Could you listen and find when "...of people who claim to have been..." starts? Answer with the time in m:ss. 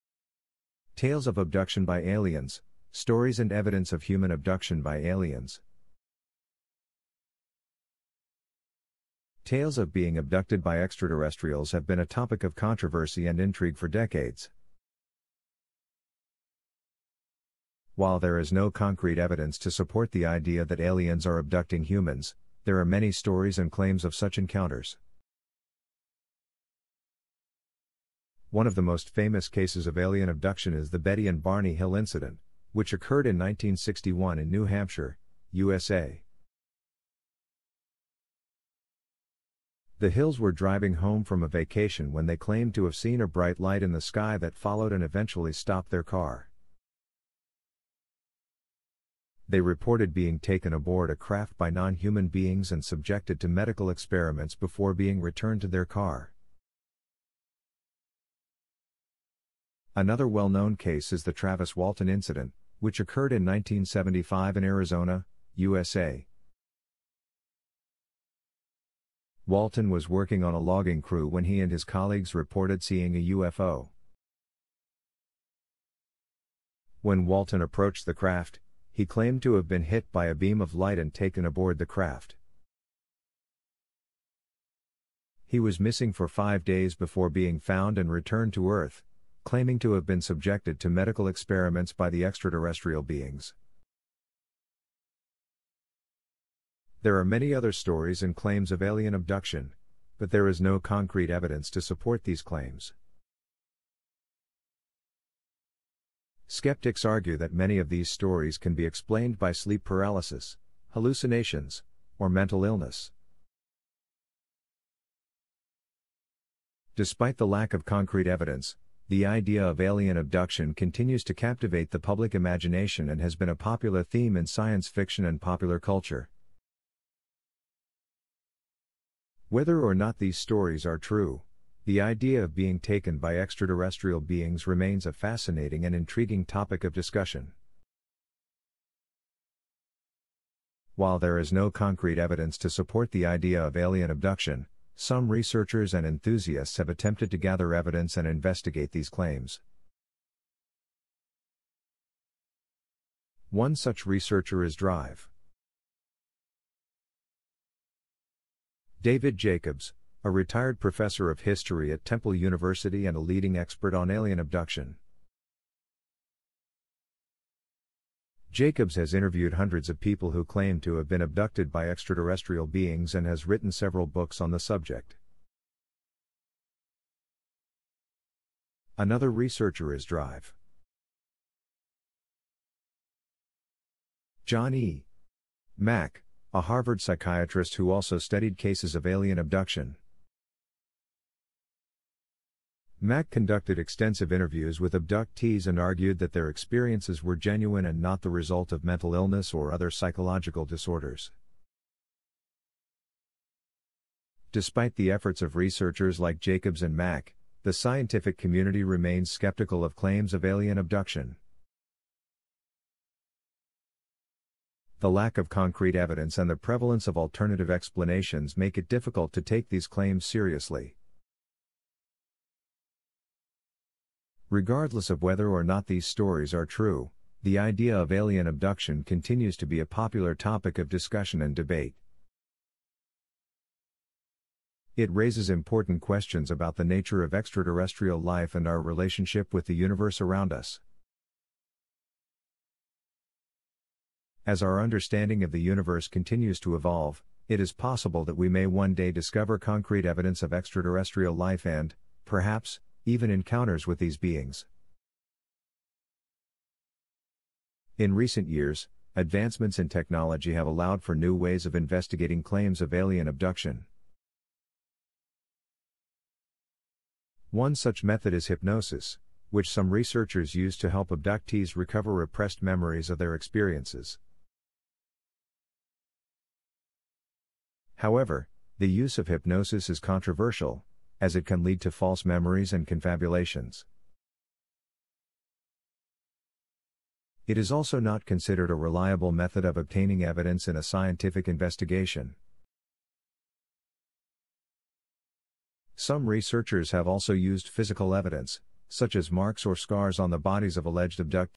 2:49.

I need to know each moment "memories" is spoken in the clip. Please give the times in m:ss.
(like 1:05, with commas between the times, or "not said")
4:32, 4:42.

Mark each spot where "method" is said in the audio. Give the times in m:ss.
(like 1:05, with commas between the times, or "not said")
4:28, 4:49.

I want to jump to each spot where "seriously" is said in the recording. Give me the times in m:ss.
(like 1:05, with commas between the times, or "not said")
3:40.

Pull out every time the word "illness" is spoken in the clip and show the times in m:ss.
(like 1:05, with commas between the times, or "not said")
1:52, 3:19.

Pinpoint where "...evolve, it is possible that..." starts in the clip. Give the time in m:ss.
4:06.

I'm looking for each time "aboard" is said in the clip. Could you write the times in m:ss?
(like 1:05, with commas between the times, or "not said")
0:50, 1:21.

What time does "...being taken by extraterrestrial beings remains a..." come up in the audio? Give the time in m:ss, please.
2:12.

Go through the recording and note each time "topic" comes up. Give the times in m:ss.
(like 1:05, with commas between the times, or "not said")
0:12, 2:16, 3:50.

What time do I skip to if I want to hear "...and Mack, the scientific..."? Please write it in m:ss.
3:26.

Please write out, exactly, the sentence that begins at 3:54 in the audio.
It raises important questions about the nature of extraterrestrial life and our relationship with the universe around us.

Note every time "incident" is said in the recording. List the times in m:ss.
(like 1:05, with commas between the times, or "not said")
0:31, 1:02.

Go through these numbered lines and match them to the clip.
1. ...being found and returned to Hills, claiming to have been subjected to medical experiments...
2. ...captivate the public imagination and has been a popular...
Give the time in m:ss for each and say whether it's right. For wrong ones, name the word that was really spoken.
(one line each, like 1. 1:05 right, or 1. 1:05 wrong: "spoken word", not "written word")
1. 1:27 wrong: "Earth", not "Hills"
2. 2:01 right.